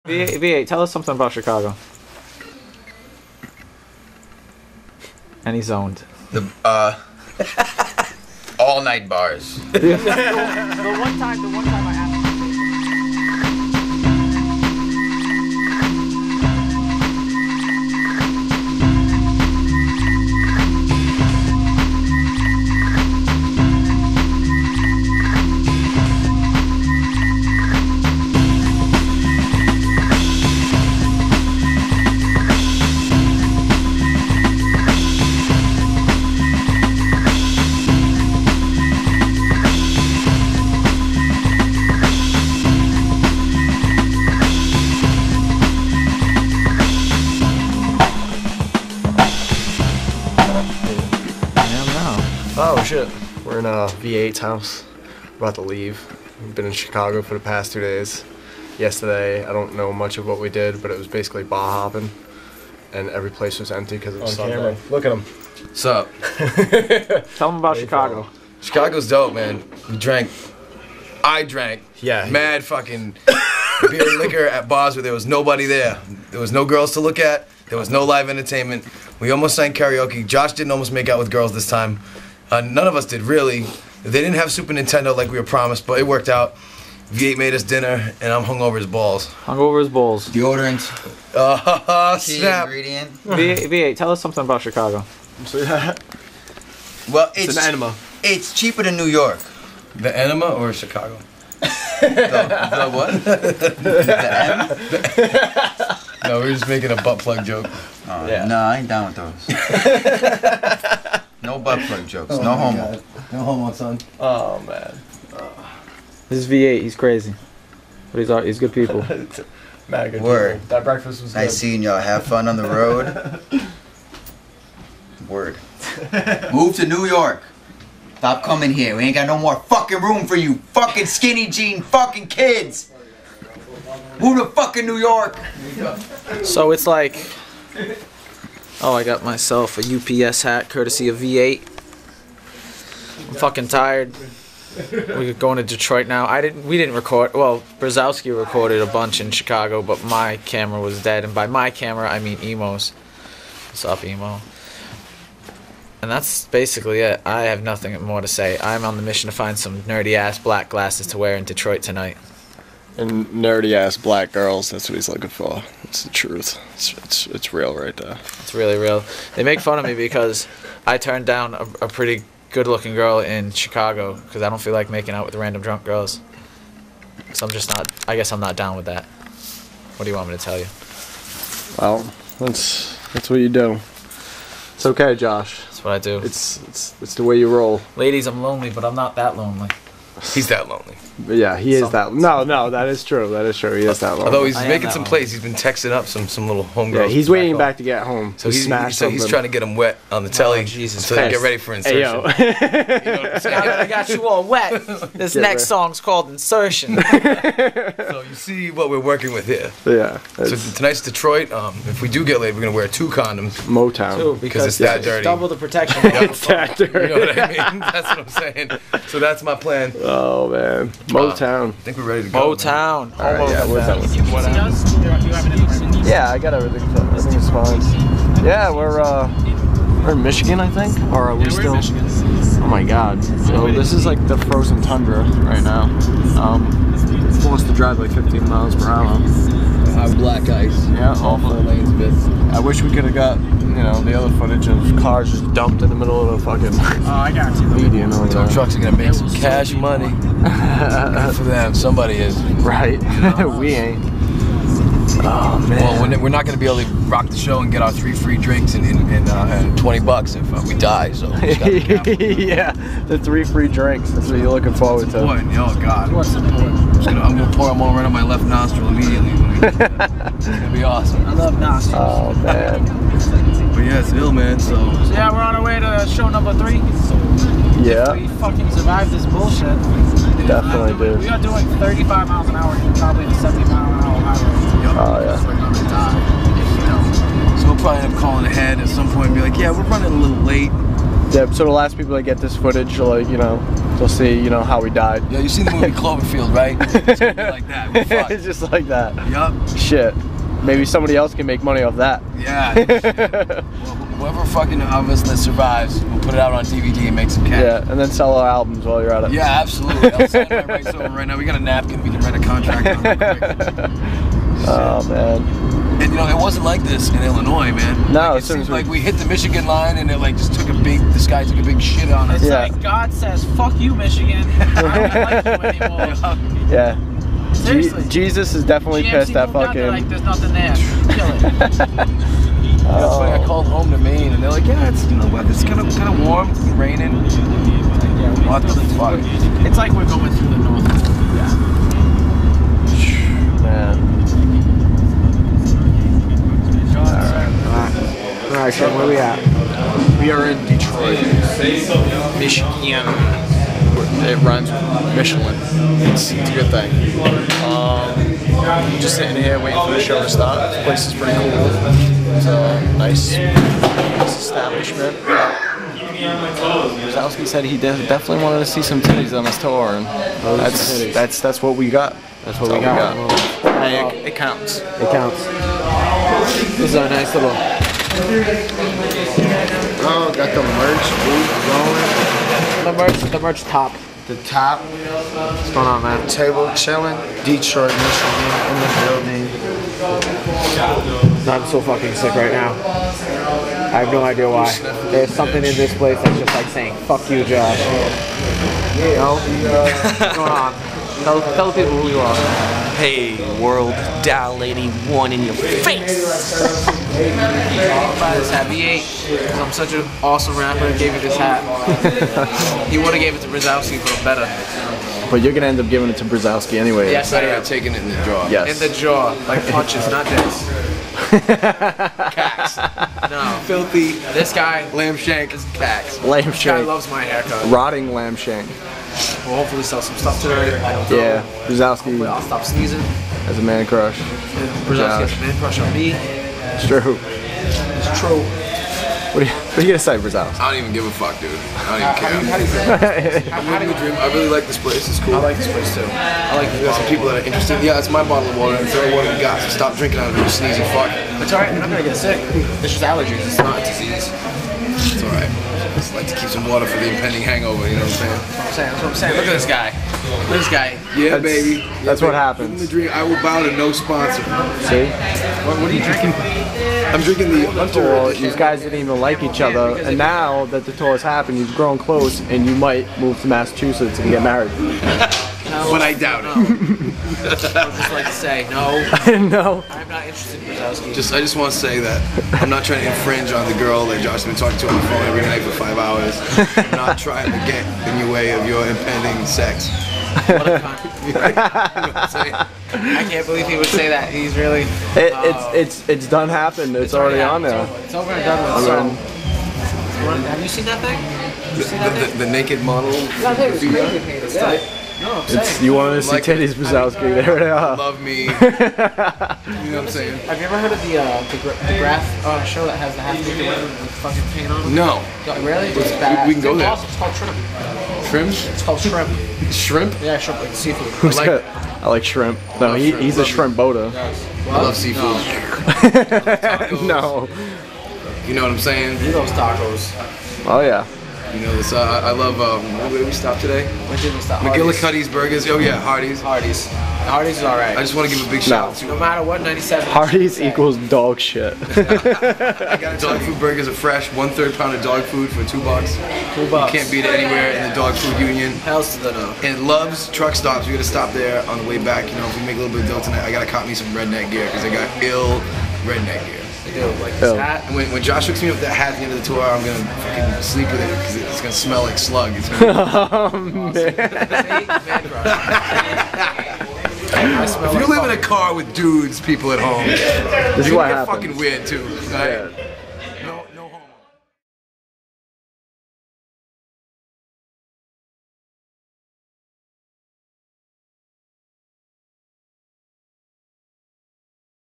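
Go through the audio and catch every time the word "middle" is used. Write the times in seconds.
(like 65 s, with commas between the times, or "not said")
245 s.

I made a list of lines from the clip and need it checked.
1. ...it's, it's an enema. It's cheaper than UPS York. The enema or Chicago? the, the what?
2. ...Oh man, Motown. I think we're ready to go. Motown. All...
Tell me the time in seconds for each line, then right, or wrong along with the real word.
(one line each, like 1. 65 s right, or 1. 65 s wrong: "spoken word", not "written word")
1. 97 s wrong: "New", not "UPS"
2. 220 s right.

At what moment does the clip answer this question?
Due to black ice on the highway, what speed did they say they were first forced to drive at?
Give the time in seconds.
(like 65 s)
238 s.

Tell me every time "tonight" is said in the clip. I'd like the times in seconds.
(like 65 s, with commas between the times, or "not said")
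161 s, 210 s, 553 s.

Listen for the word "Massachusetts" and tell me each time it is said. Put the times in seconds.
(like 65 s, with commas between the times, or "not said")
473 s.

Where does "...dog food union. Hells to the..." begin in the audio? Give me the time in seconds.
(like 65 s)
547 s.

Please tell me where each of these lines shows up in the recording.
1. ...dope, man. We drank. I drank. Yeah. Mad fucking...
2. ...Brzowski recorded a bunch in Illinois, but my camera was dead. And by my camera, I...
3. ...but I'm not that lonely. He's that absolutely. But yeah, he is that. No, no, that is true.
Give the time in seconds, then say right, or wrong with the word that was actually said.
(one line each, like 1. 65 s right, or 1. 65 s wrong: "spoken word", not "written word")
1. 69 s right
2. 147 s wrong: "Chicago", not "Illinois"
3. 188 s wrong: "lonely", not "absolutely".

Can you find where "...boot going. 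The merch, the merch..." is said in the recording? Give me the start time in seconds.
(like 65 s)
382 s.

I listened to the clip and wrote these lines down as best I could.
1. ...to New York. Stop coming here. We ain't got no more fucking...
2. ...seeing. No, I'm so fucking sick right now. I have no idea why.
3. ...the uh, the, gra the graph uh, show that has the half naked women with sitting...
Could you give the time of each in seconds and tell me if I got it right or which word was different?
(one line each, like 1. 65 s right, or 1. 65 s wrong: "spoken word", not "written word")
1. 126 s right
2. 389 s wrong: "building", not "seeing"
3. 511 s wrong: "fucking", not "sitting".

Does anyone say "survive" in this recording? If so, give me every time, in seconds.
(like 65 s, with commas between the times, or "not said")
278 s, 305 s.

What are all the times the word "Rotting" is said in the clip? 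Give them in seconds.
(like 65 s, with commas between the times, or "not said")
427 s.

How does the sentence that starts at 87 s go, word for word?
V8 made us dinner, and I'm hung over his balls.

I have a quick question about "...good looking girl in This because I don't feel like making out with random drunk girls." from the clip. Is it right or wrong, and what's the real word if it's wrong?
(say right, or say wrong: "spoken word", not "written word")
wrong: "Chicago", not "This".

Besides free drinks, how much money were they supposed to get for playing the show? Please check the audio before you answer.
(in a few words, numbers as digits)
20 bucks.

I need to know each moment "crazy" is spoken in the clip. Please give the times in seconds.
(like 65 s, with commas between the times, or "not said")
116 s, 503 s.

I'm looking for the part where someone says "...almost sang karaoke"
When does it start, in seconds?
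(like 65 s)
79 s.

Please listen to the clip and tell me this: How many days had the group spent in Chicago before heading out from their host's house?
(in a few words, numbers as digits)
2.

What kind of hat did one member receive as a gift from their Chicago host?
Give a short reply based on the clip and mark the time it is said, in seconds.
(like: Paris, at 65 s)
UPS hat, at 140 s.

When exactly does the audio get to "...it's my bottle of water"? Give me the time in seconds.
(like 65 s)
447 s.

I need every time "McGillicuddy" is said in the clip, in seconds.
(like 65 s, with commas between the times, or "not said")
534 s.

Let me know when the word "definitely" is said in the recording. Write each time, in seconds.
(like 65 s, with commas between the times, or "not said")
280 s, 328 s, 367 s.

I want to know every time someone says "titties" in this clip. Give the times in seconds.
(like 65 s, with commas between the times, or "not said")
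369 s, 506 s.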